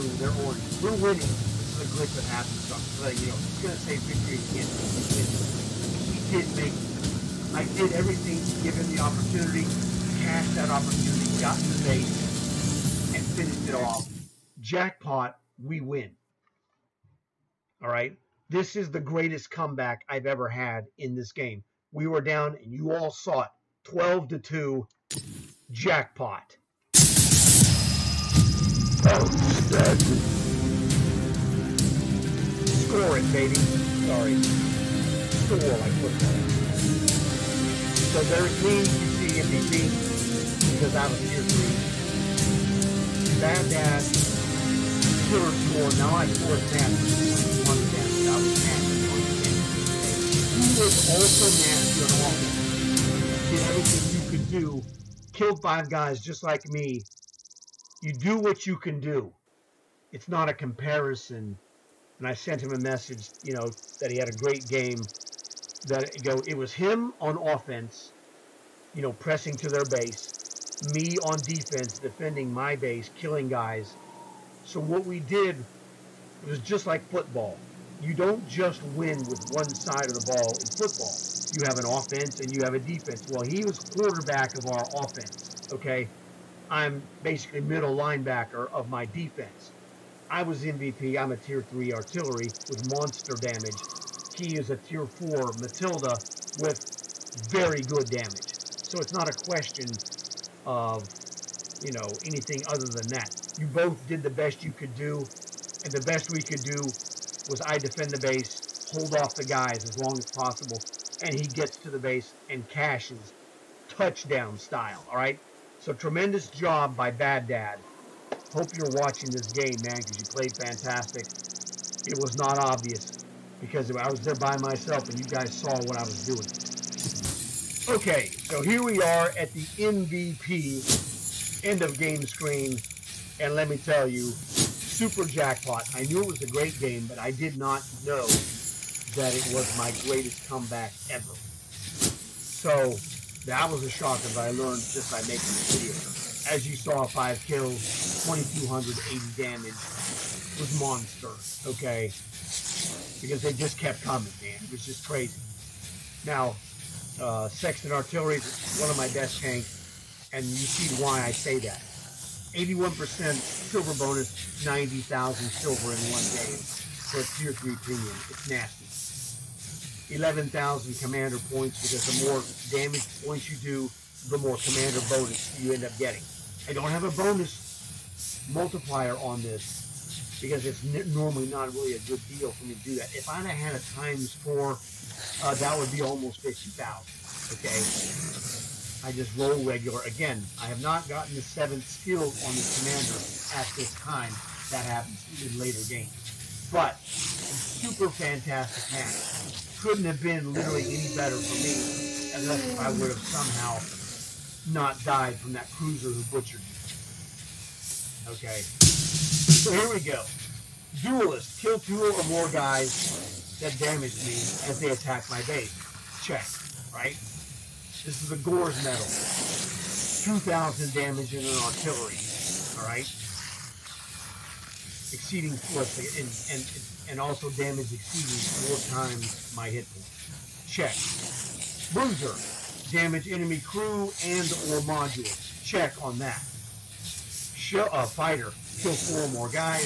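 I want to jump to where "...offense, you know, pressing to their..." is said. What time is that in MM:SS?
01:07.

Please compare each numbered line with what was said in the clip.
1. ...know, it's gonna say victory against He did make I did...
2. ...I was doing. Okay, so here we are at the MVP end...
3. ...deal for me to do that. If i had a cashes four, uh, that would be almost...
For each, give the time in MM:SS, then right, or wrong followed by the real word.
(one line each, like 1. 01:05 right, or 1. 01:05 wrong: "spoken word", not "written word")
1. 00:03 right
2. 02:05 right
3. 03:02 wrong: "times", not "cashes".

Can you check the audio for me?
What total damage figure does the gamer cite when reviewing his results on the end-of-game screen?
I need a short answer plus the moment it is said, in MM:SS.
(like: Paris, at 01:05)
2,280, at 02:28.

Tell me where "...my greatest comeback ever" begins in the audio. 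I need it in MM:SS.
02:19.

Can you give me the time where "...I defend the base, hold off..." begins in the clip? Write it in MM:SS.
01:47.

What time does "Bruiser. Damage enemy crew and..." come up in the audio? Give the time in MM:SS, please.
03:51.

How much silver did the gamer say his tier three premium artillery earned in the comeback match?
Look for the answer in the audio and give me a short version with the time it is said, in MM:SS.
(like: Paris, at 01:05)
90,000, at 02:44.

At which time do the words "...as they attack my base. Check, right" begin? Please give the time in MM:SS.
03:34.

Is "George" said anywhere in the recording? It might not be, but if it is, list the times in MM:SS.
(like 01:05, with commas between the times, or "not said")
not said.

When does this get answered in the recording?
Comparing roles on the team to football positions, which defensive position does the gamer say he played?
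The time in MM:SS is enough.
01:27.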